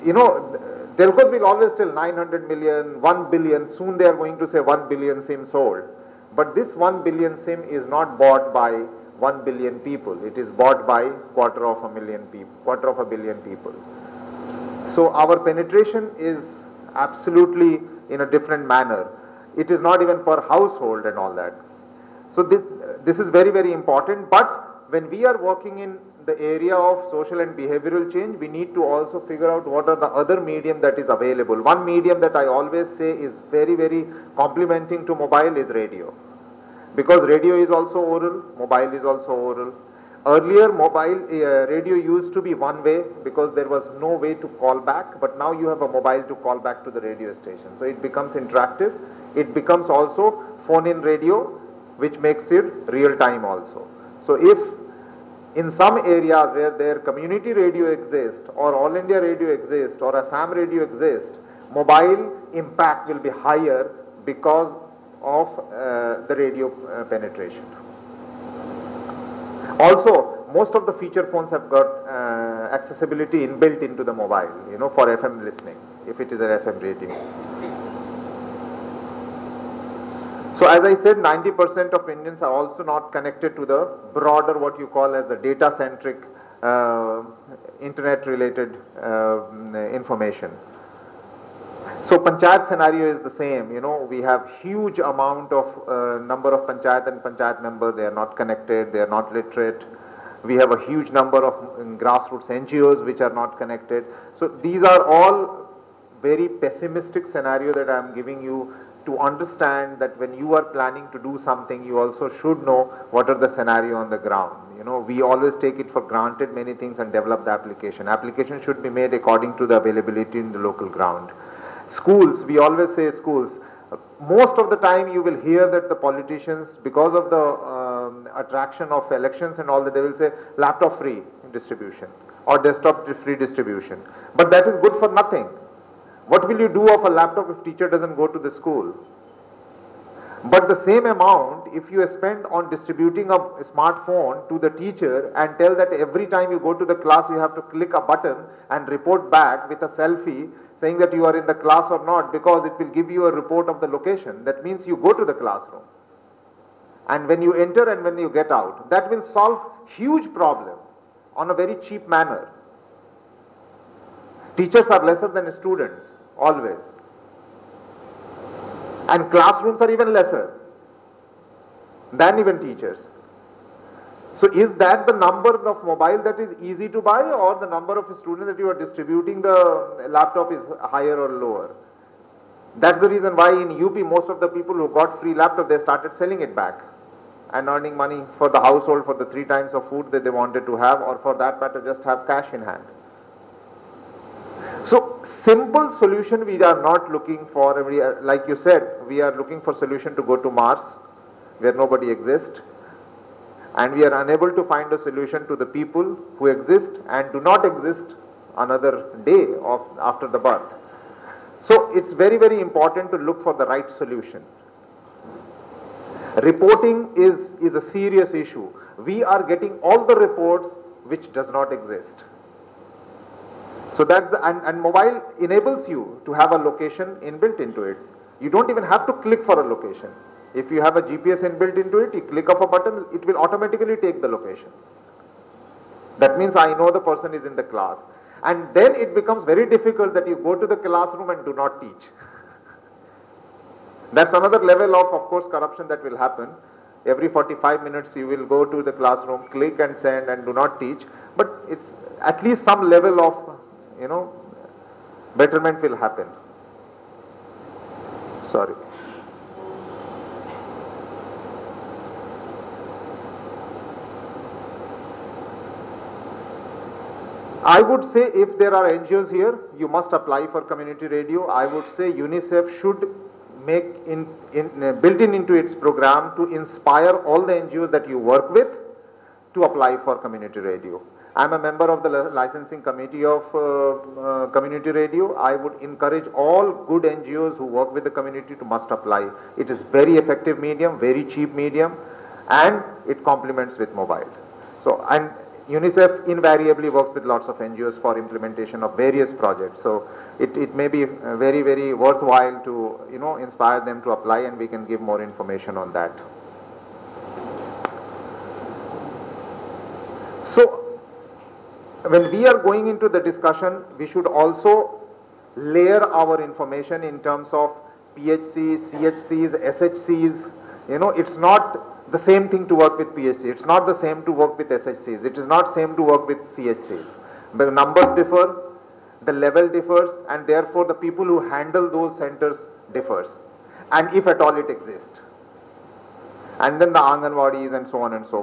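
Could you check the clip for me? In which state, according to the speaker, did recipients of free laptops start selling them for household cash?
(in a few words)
UP.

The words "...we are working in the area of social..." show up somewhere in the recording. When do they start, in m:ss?
0:25.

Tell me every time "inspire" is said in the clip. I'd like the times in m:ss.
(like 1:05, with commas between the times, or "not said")
4:36, 5:03.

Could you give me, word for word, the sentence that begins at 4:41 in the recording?
I'm a member of the licensing committee of uh, uh, community radio.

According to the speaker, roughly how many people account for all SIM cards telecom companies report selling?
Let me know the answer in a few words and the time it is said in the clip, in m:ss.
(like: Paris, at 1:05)
quarter of a billion, at 0:12.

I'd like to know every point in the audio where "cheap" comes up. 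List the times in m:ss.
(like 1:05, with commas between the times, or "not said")
2:41, 4:51.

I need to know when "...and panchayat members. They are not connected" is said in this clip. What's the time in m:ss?
1:37.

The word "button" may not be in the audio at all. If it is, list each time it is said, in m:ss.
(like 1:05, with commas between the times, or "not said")
2:27, 3:52.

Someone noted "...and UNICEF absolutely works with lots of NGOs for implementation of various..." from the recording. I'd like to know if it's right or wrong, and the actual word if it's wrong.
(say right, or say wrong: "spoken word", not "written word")
wrong: "invariably", not "absolutely".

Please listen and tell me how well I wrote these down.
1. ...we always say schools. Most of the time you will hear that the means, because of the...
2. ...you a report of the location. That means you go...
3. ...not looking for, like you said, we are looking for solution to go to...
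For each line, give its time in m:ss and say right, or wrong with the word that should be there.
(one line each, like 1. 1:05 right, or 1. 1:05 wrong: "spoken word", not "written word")
1. 2:02 wrong: "politicians", not "means"
2. 2:33 right
3. 3:16 right.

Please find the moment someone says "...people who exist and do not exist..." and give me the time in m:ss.
3:25.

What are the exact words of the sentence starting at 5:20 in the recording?
You know, it's not the same thing to work with PHC.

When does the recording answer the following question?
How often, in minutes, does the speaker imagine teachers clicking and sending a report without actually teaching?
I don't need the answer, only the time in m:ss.
4:07.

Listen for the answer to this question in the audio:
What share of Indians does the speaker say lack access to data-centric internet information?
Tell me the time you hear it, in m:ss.
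1:21.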